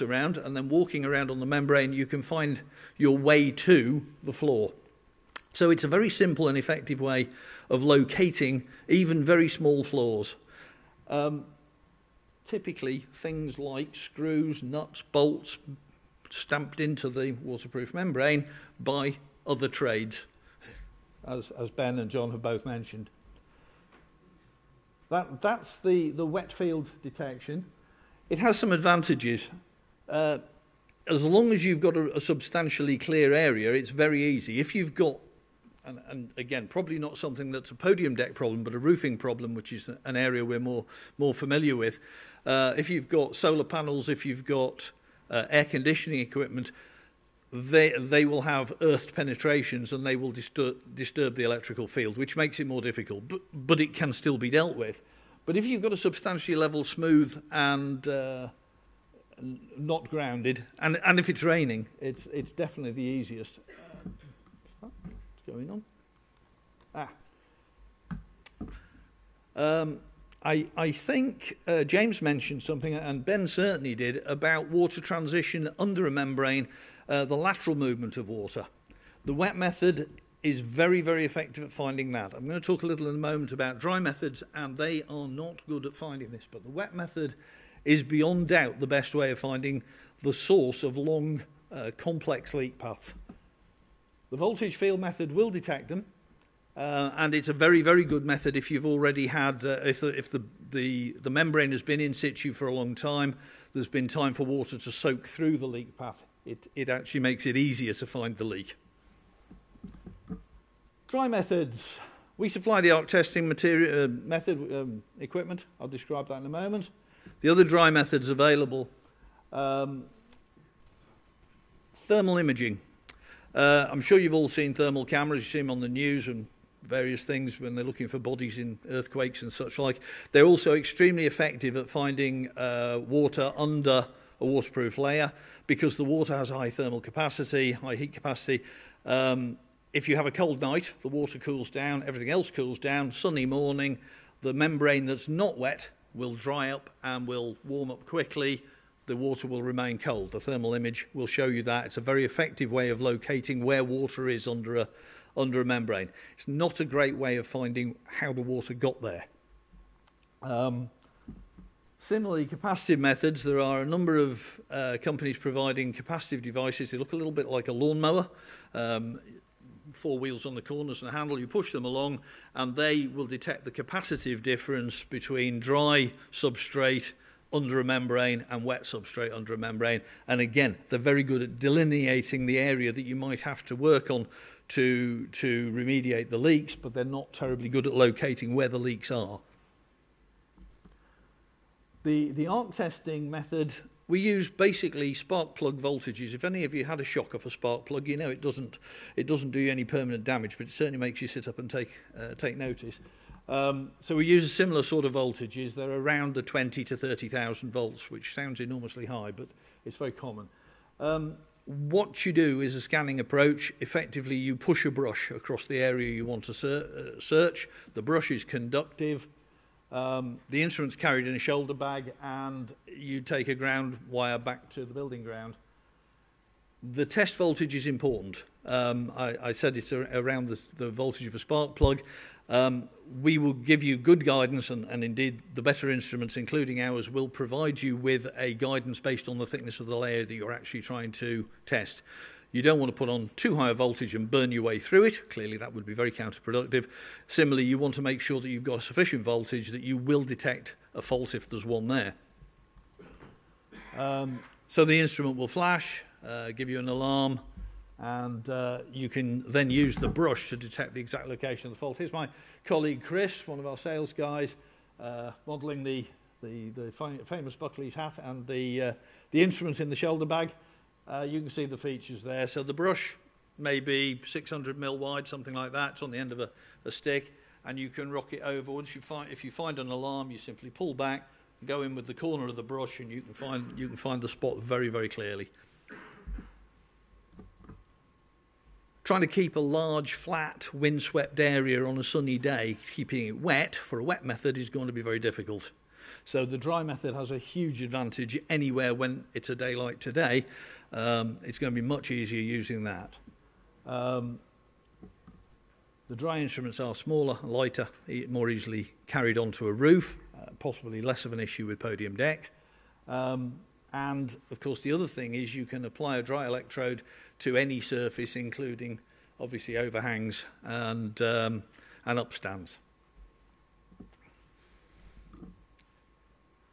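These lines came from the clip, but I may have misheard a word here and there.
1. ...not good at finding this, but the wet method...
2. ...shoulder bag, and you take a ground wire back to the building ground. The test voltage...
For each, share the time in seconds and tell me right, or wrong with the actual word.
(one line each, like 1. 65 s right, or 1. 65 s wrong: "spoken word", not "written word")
1. 85 s right
2. 221 s right.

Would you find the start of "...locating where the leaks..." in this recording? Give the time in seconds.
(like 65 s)
187 s.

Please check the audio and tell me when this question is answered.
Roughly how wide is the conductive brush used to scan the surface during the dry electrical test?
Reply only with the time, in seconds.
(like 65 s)
274 s.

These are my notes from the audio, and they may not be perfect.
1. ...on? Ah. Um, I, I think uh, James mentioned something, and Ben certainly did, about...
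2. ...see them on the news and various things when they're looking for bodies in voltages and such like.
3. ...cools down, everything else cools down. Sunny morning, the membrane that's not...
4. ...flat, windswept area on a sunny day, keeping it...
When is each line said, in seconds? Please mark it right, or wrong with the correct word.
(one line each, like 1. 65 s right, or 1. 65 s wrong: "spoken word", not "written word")
1. 65 s right
2. 125 s wrong: "earthquakes", not "voltages"
3. 141 s right
4. 290 s right.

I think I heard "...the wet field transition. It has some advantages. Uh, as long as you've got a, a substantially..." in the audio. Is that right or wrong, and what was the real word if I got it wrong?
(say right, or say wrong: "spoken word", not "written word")
wrong: "detection", not "transition".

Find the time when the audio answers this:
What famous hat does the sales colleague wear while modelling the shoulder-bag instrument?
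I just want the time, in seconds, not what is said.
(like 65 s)
267 s.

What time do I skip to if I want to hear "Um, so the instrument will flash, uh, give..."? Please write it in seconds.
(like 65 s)
253 s.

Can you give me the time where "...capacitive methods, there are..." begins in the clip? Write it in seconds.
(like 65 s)
162 s.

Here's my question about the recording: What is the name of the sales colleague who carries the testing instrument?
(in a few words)
Chris.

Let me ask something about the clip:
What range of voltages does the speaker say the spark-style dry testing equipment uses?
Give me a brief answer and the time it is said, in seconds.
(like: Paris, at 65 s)
20,000 to 30,000 volts, at 206 s.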